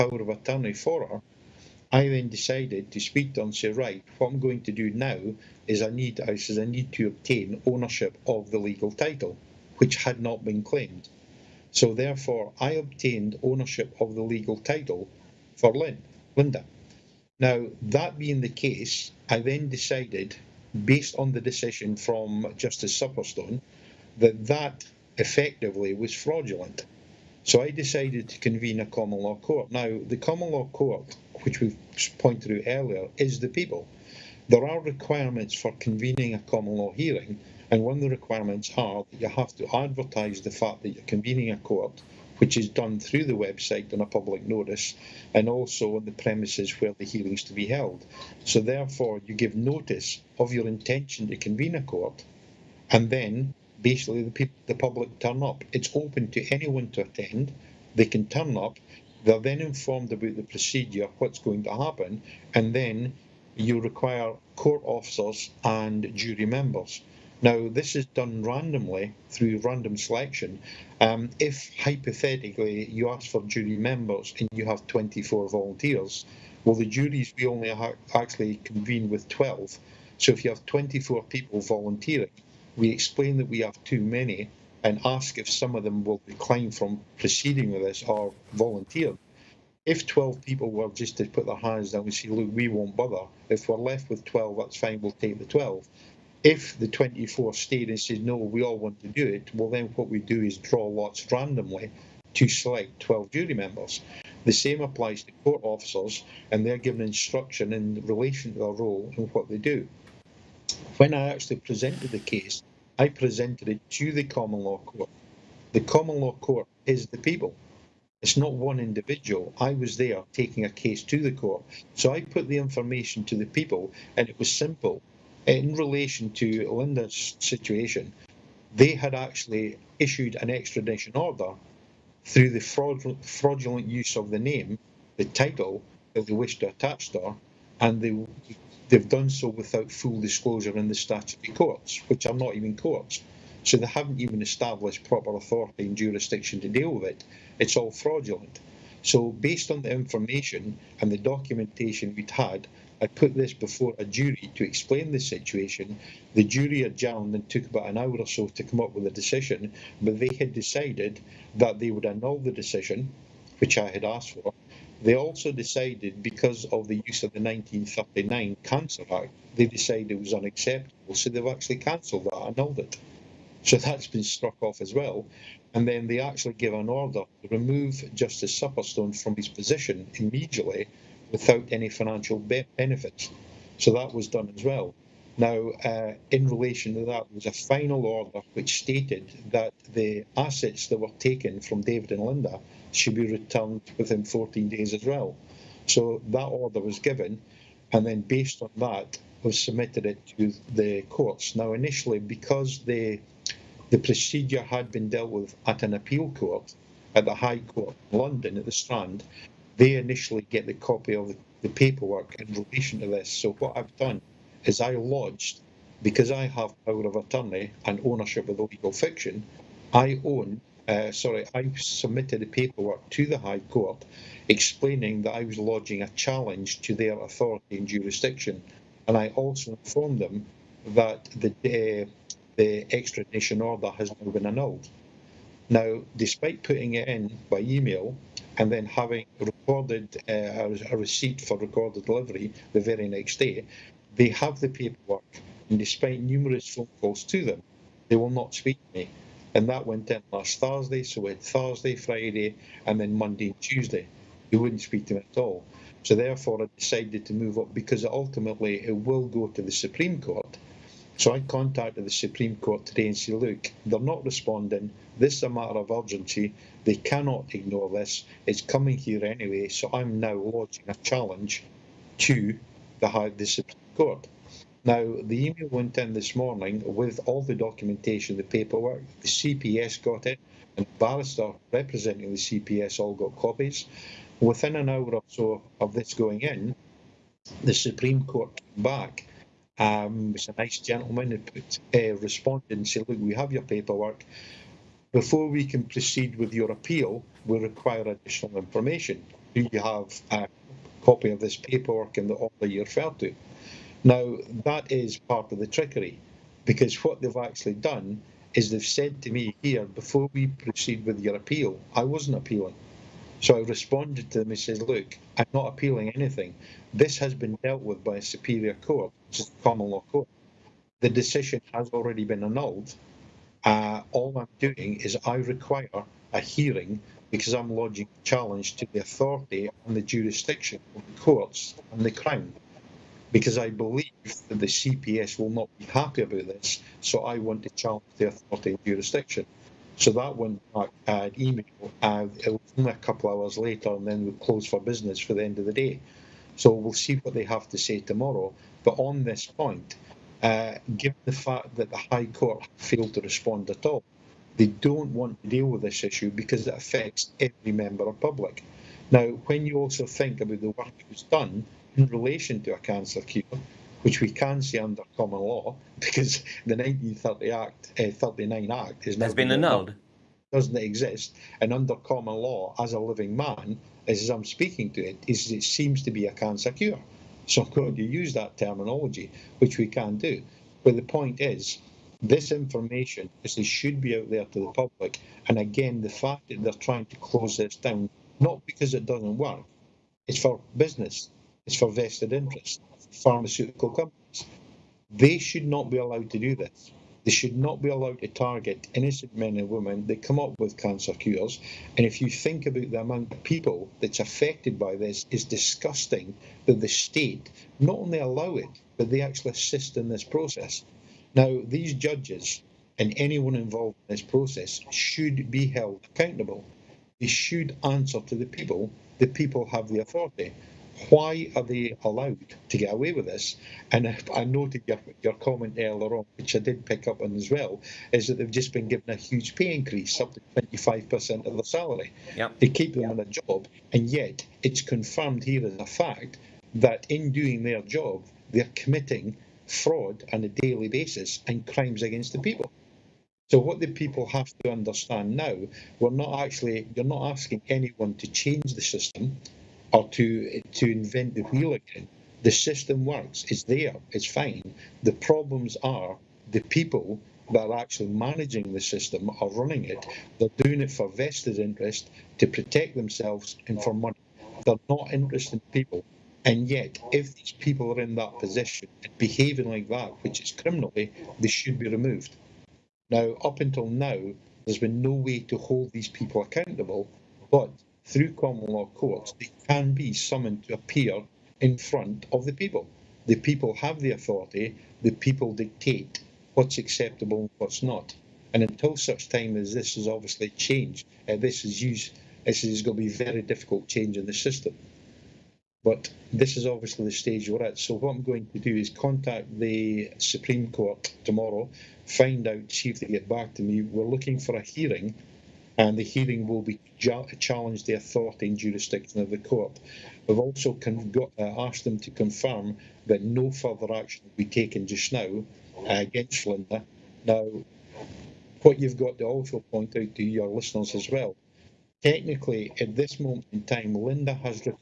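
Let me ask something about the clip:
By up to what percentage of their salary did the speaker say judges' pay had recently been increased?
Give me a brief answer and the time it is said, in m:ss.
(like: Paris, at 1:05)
25%, at 7:10.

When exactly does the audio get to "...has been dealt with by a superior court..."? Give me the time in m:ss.
5:17.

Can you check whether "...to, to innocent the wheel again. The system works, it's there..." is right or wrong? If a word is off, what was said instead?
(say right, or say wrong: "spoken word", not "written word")
wrong: "invent", not "innocent".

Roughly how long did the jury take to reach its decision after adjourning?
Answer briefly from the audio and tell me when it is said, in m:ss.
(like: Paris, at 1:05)
about an hour, at 2:37.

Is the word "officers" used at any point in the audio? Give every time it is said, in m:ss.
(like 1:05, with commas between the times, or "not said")
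1:04, 1:45.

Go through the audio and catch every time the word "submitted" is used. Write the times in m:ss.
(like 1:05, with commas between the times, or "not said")
3:19, 3:41.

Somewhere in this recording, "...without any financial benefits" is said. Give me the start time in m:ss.
3:01.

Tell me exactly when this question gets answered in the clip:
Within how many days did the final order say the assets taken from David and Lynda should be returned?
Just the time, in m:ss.
3:14.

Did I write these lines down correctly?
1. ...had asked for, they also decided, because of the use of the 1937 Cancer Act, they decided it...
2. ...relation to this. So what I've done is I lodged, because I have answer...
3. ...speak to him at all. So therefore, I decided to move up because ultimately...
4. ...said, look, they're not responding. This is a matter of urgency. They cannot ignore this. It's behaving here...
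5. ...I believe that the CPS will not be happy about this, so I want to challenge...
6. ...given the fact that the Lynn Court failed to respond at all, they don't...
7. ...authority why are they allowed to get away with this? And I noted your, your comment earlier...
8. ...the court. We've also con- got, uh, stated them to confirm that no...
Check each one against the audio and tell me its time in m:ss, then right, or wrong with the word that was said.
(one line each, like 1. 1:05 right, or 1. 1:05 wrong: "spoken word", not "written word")
1. 2:43 wrong: "1939", not "1937"
2. 3:32 wrong: "power", not "answer"
3. 4:14 right
4. 4:23 wrong: "coming", not "behaving"
5. 5:33 right
6. 5:50 wrong: "High", not "Lynn"
7. 6:59 right
8. 8:29 wrong: "asked", not "stated".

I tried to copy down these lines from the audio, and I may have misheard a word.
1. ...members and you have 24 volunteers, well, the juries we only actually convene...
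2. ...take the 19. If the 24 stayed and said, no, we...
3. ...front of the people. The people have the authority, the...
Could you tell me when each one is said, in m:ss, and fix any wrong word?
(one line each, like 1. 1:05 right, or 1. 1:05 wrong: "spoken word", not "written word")
1. 1:13 right
2. 1:35 wrong: "12", not "19"
3. 8:01 right.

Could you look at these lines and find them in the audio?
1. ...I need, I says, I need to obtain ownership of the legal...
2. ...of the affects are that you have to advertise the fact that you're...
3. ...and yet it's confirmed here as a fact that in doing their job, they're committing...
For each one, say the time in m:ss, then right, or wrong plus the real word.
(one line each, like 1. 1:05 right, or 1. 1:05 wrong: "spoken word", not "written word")
1. 0:05 right
2. 0:37 wrong: "requirements", not "affects"
3. 7:13 right.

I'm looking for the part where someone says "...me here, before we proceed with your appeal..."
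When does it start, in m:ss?
5:09.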